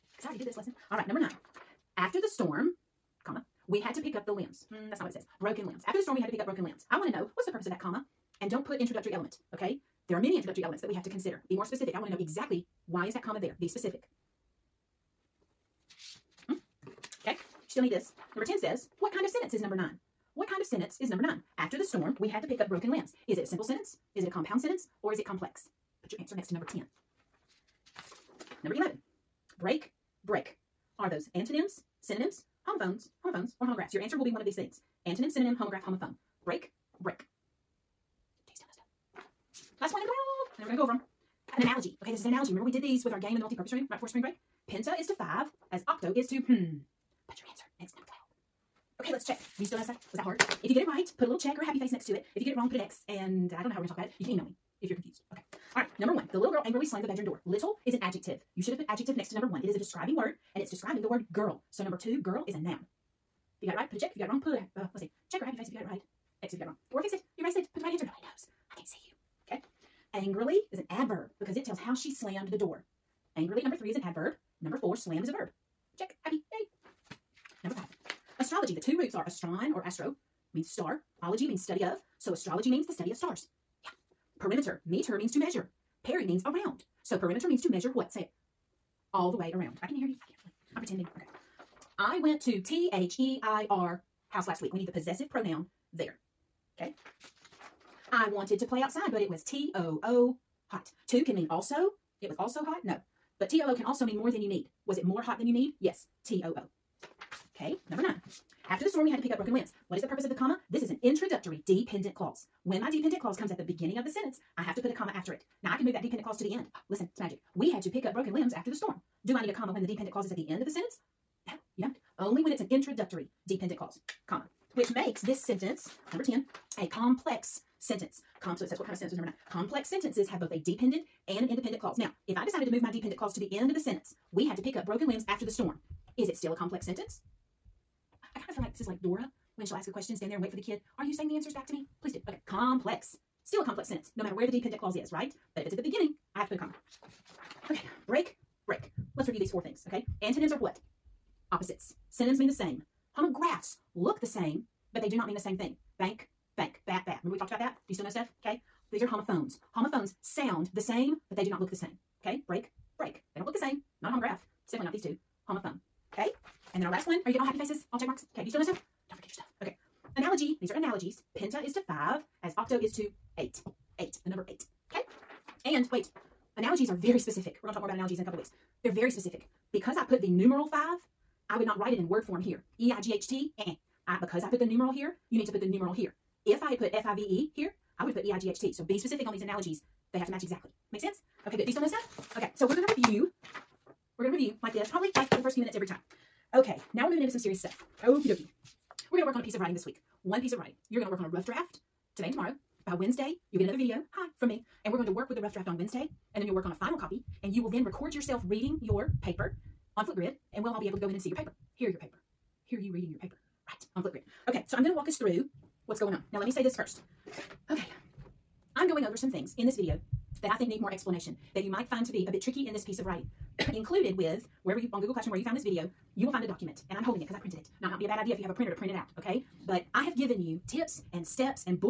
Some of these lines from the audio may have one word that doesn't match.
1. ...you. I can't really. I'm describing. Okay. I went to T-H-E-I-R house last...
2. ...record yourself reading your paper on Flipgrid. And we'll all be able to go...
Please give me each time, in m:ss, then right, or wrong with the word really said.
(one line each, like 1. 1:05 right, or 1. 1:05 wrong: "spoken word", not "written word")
1. 1:30 wrong: "pretending", not "describing"
2. 3:27 right.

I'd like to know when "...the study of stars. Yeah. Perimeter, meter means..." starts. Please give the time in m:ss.
1:22.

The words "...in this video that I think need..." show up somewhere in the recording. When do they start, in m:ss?
3:39.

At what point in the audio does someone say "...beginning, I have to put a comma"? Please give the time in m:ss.
2:25.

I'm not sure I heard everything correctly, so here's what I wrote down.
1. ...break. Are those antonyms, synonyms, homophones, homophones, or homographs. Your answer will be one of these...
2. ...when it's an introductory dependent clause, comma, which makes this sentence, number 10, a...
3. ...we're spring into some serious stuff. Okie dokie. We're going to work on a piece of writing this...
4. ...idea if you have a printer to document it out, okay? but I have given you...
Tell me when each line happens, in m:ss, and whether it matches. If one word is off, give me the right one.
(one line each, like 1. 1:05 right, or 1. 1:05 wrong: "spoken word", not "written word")
1. 0:30 right
2. 2:02 right
3. 3:17 wrong: "moving", not "spring"
4. 3:48 wrong: "print", not "document".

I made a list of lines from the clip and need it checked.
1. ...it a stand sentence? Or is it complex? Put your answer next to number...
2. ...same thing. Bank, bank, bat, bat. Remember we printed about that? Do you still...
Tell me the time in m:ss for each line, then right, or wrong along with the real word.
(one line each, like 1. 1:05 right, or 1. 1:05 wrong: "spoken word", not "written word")
1. 0:24 wrong: "compound", not "stand"
2. 2:35 wrong: "talked", not "printed".